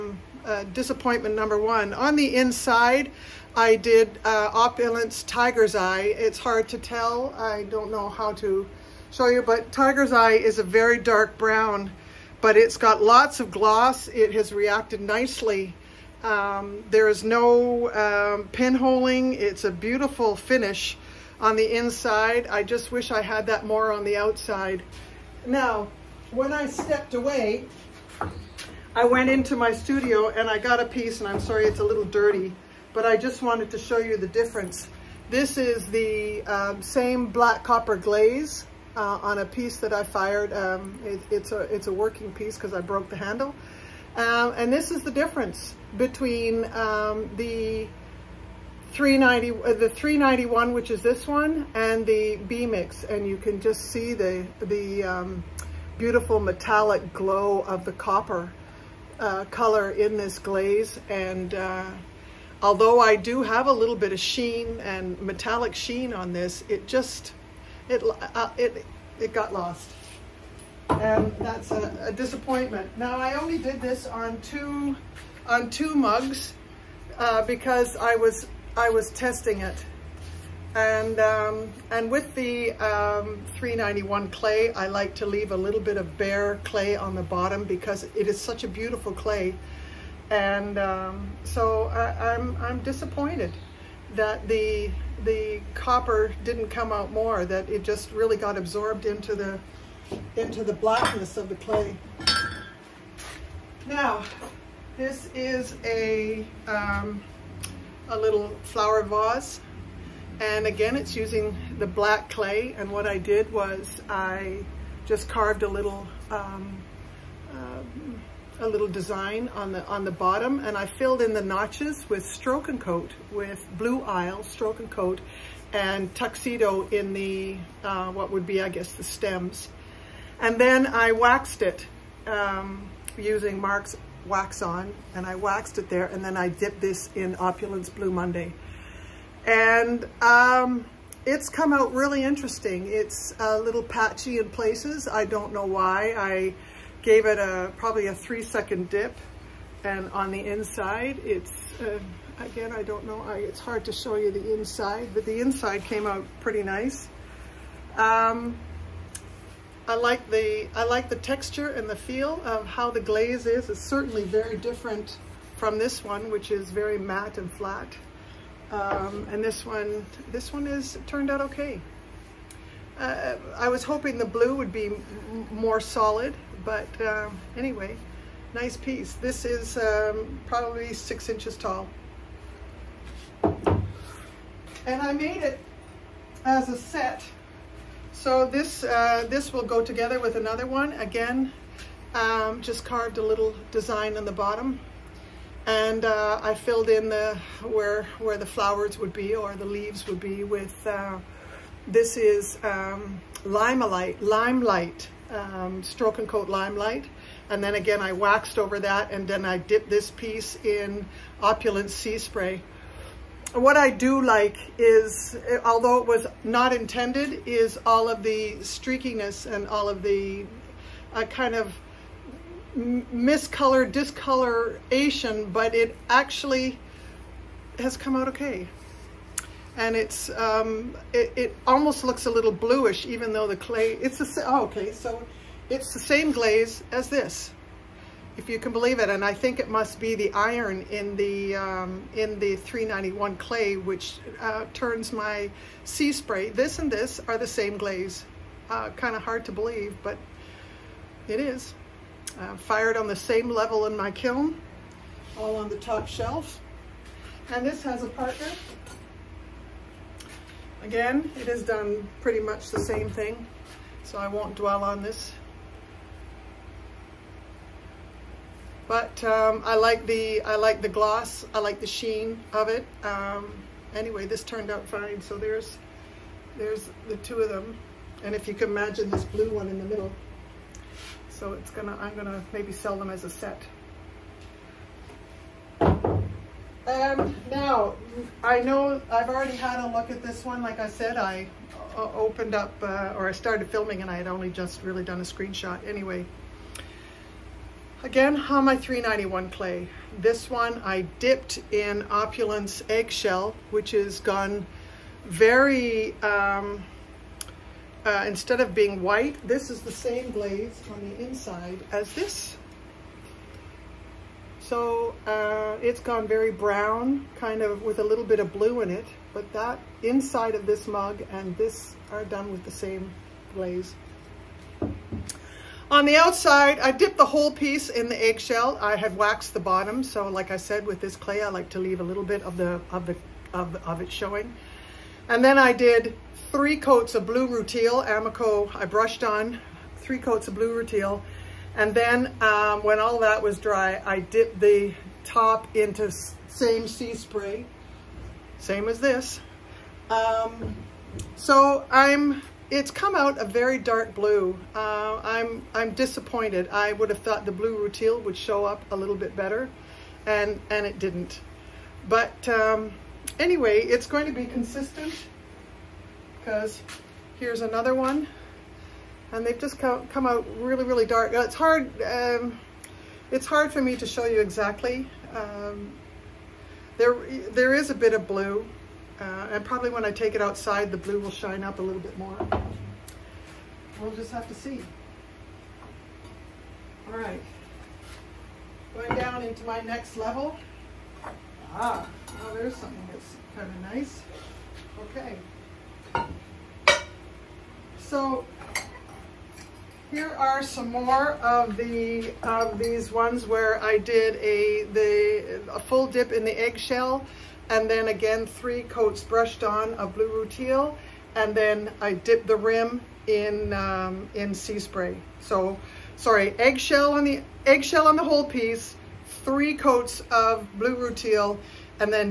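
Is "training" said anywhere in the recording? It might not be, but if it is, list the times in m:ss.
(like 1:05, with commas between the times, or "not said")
not said.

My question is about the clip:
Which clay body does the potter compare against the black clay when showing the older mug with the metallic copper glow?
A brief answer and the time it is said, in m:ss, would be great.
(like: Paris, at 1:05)
B-Mix, at 0:52.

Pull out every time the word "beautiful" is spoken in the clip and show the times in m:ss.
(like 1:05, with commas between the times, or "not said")
0:19, 0:55, 1:28.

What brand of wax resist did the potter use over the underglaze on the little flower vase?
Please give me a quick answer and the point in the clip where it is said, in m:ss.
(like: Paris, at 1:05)
Mark's wax on, at 2:13.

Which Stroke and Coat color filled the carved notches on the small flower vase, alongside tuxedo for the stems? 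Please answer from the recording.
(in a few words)
Blue Isle.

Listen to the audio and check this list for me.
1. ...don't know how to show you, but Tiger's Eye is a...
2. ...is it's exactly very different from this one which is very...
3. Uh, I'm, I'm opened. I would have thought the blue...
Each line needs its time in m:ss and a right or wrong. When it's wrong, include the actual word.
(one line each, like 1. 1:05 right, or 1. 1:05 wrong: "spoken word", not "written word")
1. 0:07 right
2. 2:43 wrong: "certainly", not "exactly"
3. 5:54 wrong: "disappointed", not "opened".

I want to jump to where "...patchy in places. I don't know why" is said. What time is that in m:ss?
2:23.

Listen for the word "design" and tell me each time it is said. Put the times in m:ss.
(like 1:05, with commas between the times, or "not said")
1:58, 3:13.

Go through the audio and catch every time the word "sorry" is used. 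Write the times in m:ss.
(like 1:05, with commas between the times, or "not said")
0:31, 6:56.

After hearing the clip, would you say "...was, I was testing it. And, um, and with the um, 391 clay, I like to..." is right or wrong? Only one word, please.
right.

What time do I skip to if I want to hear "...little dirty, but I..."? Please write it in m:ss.
0:31.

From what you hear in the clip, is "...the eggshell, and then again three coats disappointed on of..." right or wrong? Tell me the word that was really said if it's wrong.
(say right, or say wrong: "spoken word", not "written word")
wrong: "brushed", not "disappointed".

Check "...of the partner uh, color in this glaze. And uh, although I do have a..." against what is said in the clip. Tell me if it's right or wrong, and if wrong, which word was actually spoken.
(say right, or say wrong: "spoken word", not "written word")
wrong: "copper", not "partner".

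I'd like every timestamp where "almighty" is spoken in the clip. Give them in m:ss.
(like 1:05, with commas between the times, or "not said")
not said.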